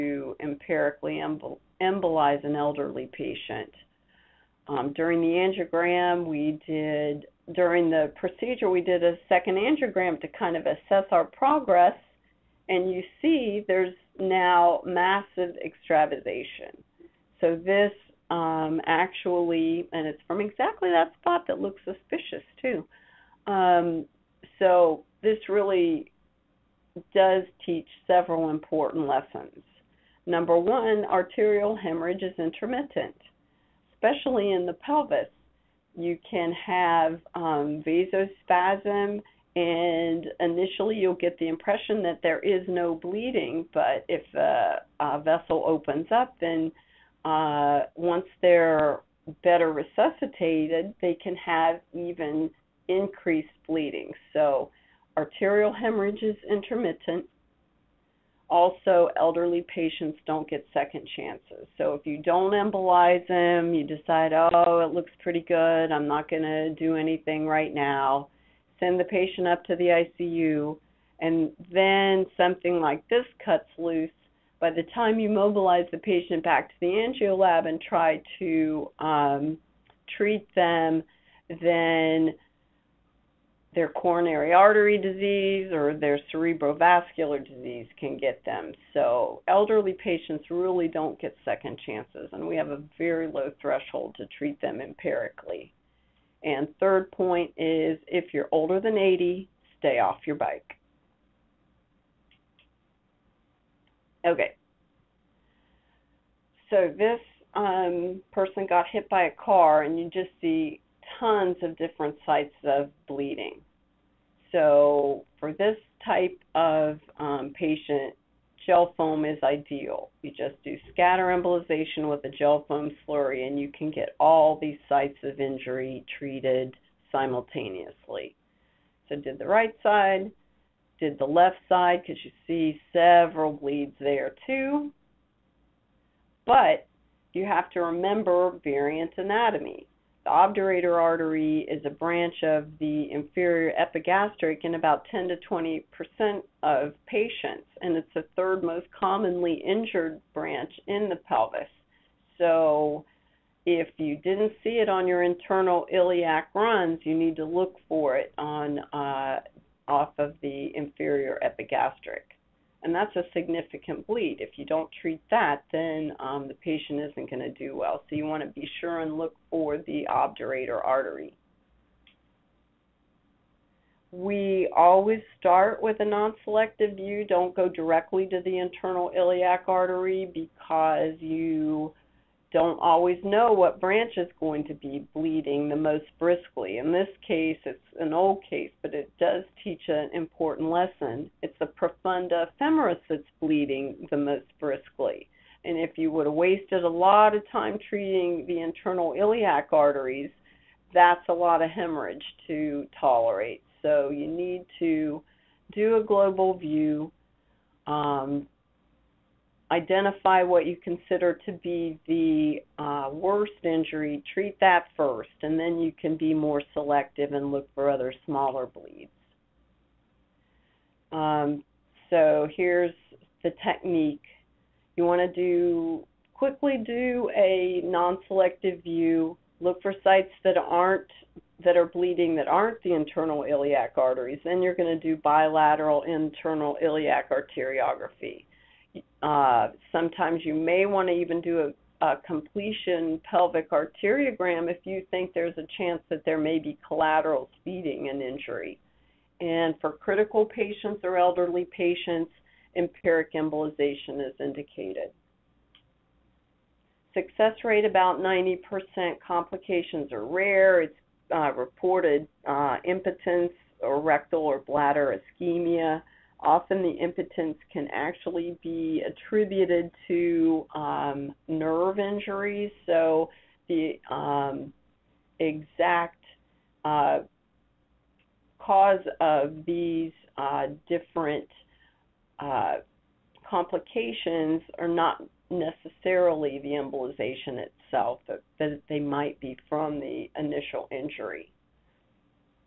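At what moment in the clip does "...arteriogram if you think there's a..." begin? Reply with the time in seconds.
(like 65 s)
243 s.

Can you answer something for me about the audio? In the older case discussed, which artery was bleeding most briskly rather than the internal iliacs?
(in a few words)
Profunda femoris.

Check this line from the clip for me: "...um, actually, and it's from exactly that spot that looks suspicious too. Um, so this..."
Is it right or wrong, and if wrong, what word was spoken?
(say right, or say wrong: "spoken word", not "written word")
right.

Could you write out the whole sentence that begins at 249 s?
And for critical patients or elderly patients, empiric embolization is indicated.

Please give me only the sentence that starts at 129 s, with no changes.
So, did the right side, did the left side, because you see several bleeds there too.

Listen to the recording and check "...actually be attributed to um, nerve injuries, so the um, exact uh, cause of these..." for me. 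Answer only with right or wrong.
right.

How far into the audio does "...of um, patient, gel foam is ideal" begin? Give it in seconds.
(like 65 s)
116 s.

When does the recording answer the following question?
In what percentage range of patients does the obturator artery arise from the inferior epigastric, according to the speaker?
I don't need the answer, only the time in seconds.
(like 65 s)
145 s.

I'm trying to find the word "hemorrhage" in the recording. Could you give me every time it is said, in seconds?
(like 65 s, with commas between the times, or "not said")
31 s, 55 s, 201 s.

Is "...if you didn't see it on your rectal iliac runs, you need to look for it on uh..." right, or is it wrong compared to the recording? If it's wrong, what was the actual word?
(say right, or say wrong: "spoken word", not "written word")
wrong: "internal", not "rectal".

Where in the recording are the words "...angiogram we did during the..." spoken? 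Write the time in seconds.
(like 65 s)
5 s.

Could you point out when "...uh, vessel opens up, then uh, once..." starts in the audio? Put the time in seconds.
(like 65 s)
45 s.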